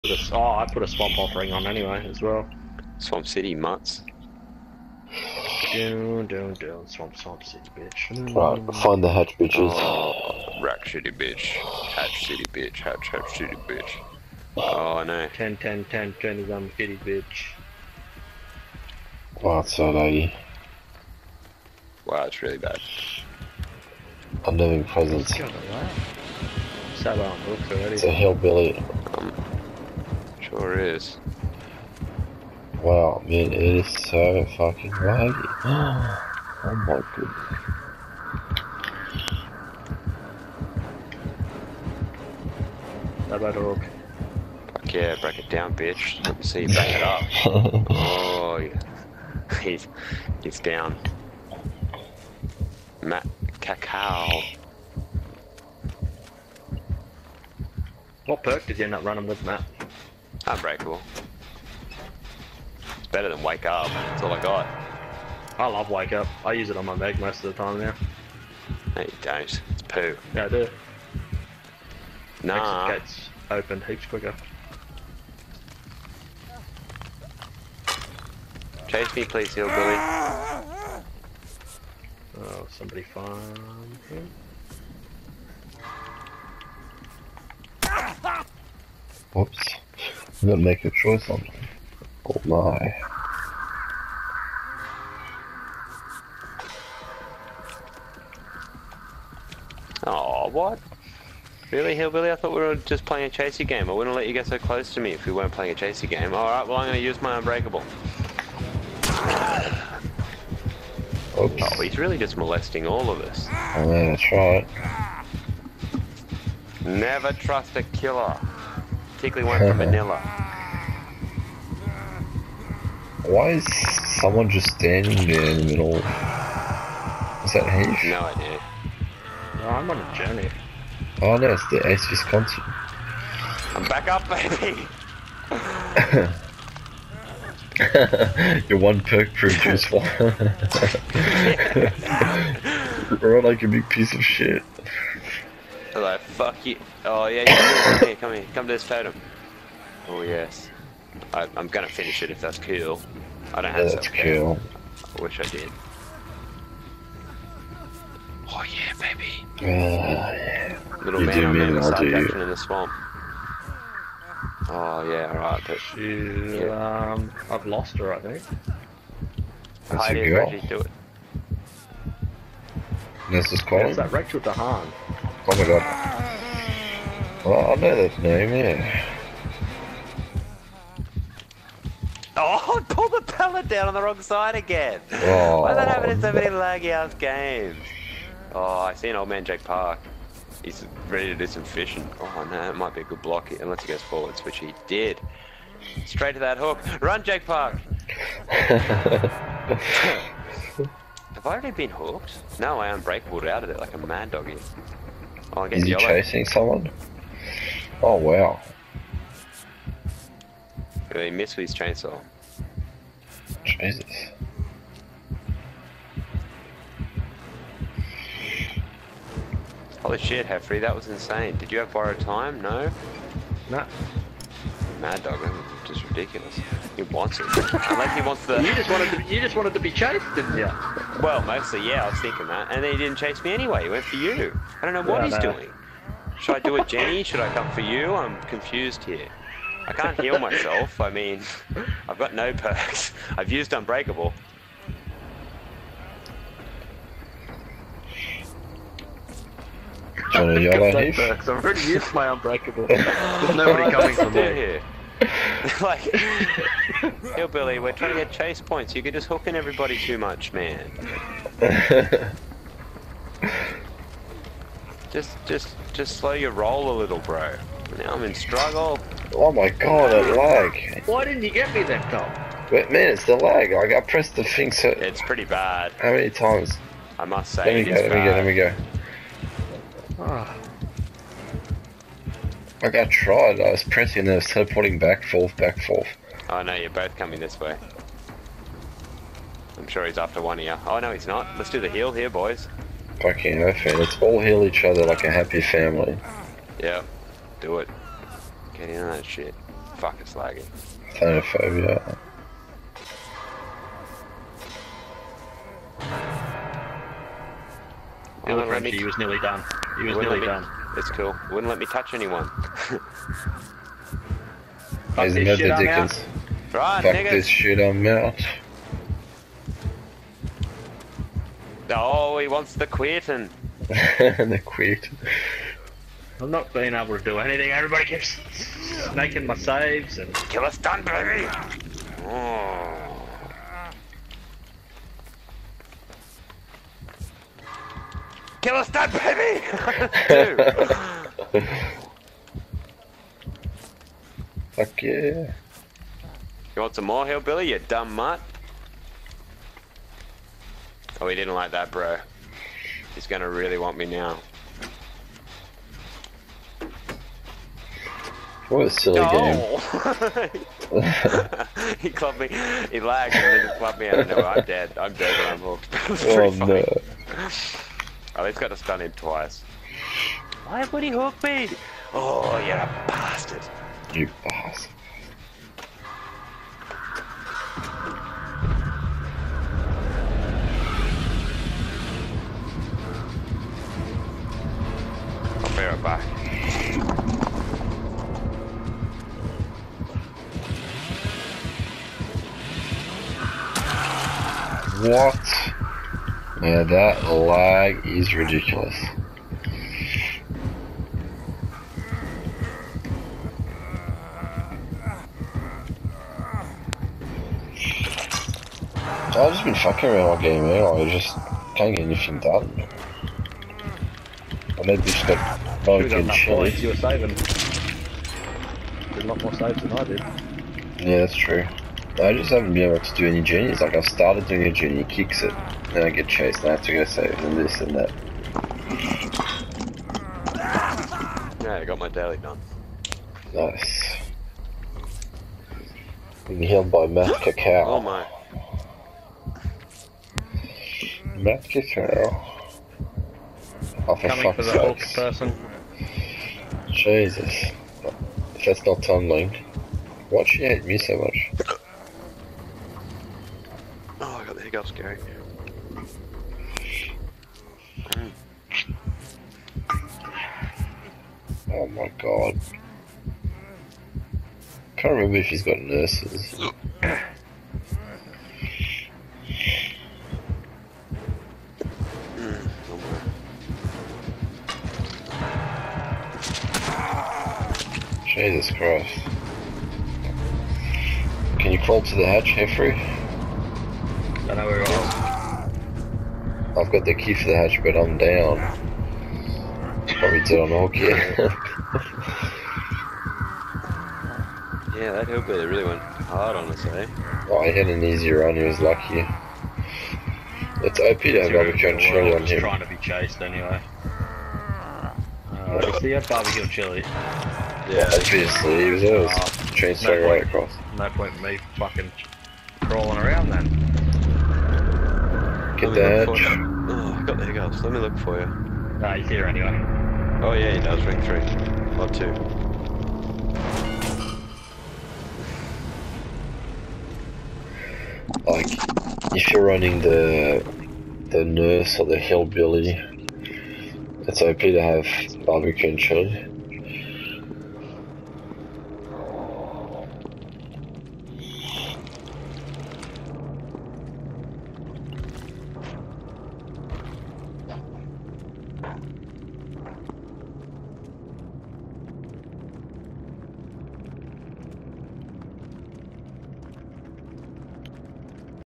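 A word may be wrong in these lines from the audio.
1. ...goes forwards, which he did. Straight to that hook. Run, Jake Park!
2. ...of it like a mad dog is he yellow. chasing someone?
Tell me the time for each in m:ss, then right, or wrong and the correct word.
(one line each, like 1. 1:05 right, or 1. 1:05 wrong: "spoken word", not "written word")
1. 3:13 right
2. 3:23 right.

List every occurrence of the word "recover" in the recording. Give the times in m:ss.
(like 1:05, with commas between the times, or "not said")
not said.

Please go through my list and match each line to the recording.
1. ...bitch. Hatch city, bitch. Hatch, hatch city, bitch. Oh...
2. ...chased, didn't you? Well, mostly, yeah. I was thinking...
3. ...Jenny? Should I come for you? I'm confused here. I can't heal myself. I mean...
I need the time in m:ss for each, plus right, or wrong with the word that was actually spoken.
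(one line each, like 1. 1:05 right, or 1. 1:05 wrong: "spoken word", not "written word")
1. 0:11 right
2. 3:49 right
3. 3:56 right.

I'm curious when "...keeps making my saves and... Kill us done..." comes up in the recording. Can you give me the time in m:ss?
5:28.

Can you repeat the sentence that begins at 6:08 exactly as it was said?
At oh, least got to stun him twice.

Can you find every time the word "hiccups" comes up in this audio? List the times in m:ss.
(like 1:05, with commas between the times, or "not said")
7:34, 8:37.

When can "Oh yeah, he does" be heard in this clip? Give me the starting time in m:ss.
8:40.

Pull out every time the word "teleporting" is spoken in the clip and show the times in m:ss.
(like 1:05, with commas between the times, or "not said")
4:44.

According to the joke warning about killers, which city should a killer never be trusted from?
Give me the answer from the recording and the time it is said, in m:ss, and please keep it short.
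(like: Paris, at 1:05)
Manila, at 1:59.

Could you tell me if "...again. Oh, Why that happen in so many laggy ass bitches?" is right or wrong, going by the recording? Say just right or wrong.
wrong.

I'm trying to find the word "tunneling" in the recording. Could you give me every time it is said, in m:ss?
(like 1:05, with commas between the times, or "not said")
7:29.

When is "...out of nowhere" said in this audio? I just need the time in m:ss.
6:04.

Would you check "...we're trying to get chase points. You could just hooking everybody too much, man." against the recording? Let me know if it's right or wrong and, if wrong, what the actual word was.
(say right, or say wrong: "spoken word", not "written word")
right.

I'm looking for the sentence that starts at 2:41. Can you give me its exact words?
Little you man, do I'm mean, in the swamp.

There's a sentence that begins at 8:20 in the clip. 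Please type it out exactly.
It's OP to have barbecue and chili on him.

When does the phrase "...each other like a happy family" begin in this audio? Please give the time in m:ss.
4:54.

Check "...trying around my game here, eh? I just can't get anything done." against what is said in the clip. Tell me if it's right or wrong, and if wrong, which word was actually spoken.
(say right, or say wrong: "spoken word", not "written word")
wrong: "fucking", not "trying".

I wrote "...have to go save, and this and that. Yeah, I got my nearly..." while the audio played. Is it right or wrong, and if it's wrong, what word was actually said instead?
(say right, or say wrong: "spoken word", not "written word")
wrong: "daily", not "nearly".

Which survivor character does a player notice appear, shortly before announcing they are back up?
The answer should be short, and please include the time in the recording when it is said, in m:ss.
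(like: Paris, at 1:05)
Ace Visconti, at 2:11.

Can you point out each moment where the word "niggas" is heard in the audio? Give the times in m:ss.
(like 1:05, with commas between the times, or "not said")
5:17.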